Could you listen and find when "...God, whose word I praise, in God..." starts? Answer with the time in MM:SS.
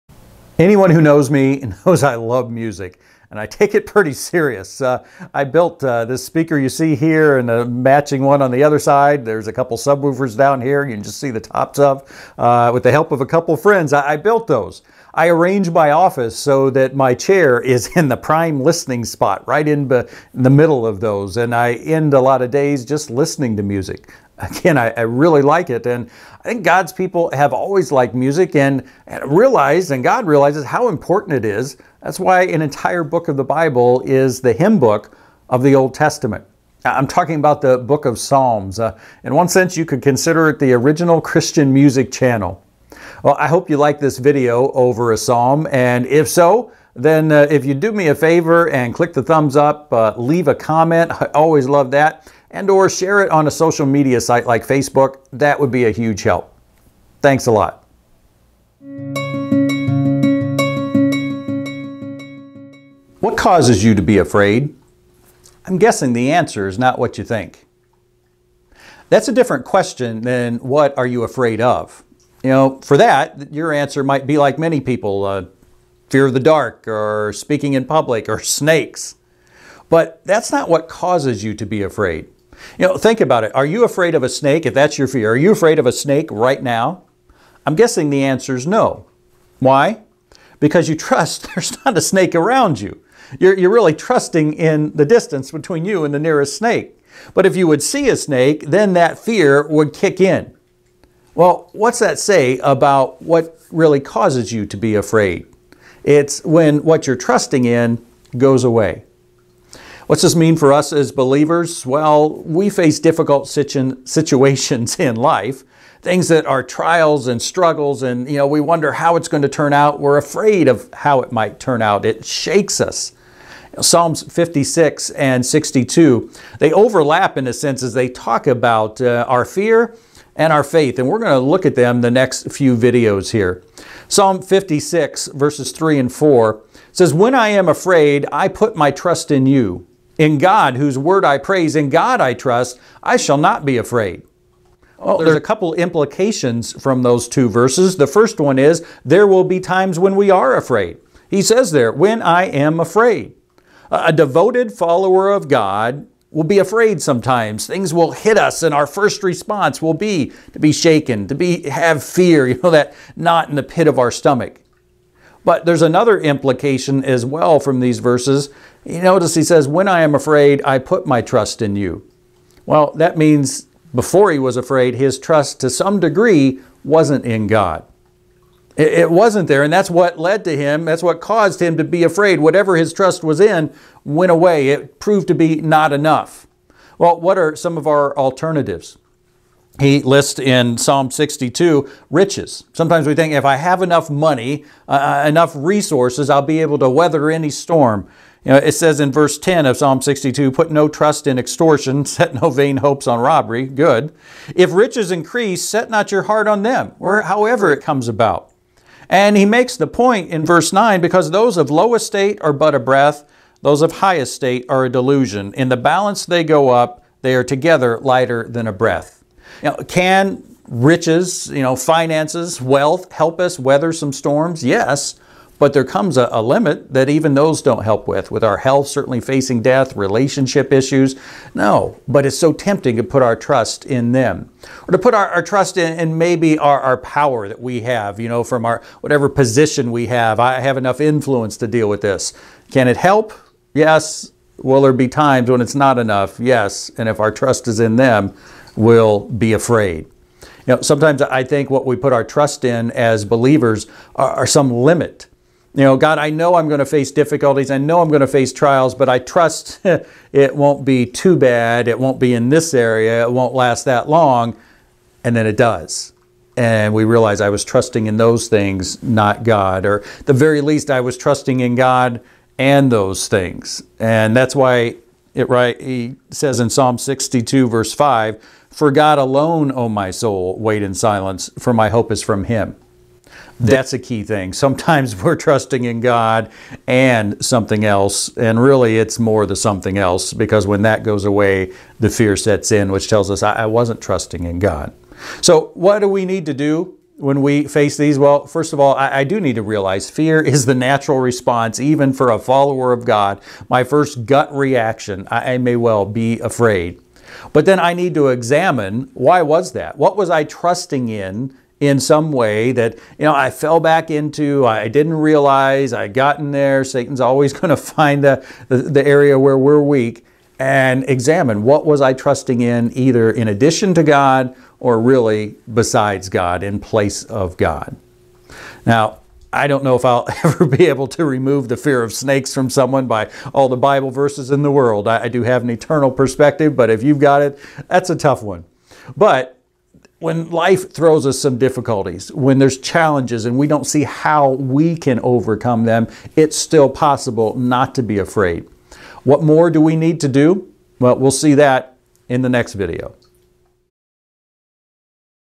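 02:20.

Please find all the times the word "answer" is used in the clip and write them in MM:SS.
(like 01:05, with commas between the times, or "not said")
01:06, 01:13, 01:28.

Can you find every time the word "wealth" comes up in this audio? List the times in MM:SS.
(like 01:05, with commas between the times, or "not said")
03:42.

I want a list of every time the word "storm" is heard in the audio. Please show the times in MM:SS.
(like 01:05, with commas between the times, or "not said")
03:17, 03:44.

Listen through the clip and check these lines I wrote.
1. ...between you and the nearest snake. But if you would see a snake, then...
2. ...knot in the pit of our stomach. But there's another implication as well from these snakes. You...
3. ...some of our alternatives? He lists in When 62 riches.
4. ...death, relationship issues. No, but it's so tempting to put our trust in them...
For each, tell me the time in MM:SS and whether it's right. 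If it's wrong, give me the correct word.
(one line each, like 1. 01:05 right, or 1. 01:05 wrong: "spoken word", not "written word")
1. 01:35 right
2. 02:43 wrong: "verses", not "snakes"
3. 03:07 wrong: "Psalm", not "When"
4. 03:49 right.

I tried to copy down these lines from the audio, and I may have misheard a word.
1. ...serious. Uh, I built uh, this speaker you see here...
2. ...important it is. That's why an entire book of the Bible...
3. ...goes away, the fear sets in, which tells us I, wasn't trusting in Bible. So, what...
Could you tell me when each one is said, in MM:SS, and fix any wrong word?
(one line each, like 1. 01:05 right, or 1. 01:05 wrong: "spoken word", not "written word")
1. 00:04 right
2. 00:30 right
3. 04:51 wrong: "God", not "Bible".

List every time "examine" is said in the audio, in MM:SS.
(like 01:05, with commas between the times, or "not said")
05:08, 05:21.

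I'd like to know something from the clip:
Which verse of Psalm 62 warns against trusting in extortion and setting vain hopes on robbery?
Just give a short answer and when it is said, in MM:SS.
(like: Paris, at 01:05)
Verse 10, at 03:19.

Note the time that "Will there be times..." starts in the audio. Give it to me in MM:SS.
04:04.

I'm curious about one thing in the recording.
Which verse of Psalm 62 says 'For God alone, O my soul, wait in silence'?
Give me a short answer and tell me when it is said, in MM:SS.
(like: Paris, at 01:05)
Verse 5, at 04:37.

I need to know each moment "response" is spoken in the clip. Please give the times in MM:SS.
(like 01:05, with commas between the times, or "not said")
02:39, 05:01.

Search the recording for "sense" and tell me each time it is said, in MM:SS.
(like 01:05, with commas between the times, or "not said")
00:39, 02:07.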